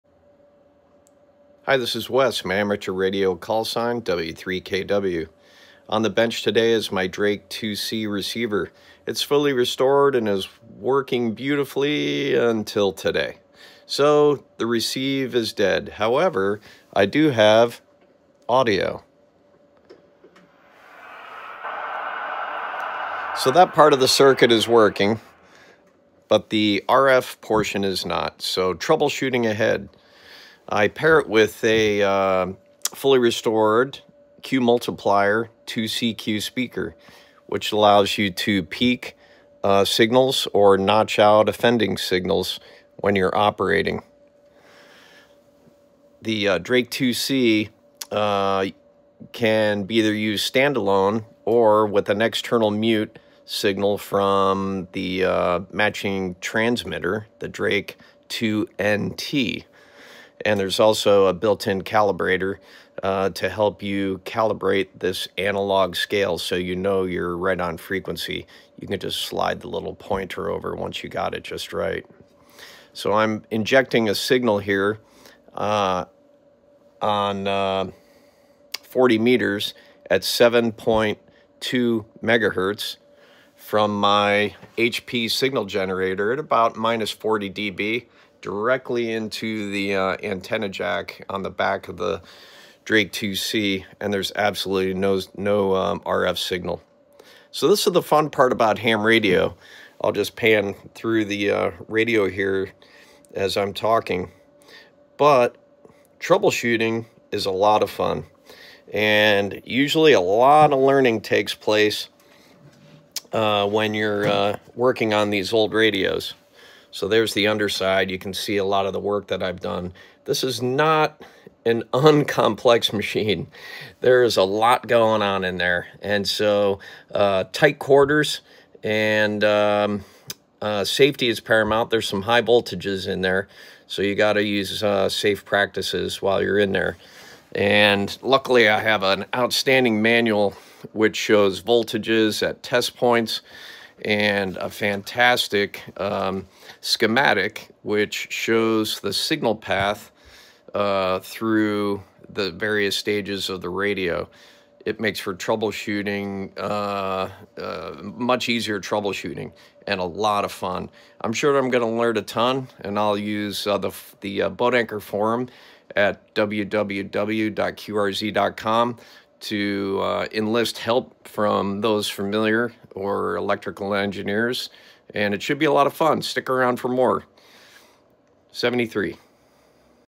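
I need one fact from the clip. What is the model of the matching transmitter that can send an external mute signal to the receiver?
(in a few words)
Drake 2NT.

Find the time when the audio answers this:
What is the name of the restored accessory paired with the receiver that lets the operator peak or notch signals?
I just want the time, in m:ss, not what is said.
0:34.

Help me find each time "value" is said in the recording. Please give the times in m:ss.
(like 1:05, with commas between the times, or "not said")
not said.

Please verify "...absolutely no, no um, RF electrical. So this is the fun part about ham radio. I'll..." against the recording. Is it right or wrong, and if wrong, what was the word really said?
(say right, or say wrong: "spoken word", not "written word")
wrong: "signal", not "electrical".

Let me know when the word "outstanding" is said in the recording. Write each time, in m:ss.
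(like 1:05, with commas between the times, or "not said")
2:19.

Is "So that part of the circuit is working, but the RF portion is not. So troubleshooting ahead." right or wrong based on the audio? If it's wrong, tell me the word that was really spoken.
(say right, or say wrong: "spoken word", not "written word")
right.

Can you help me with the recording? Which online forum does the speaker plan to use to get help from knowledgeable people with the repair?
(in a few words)
Boat Anchor forum.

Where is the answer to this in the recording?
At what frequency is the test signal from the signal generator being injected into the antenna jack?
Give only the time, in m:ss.
1:20.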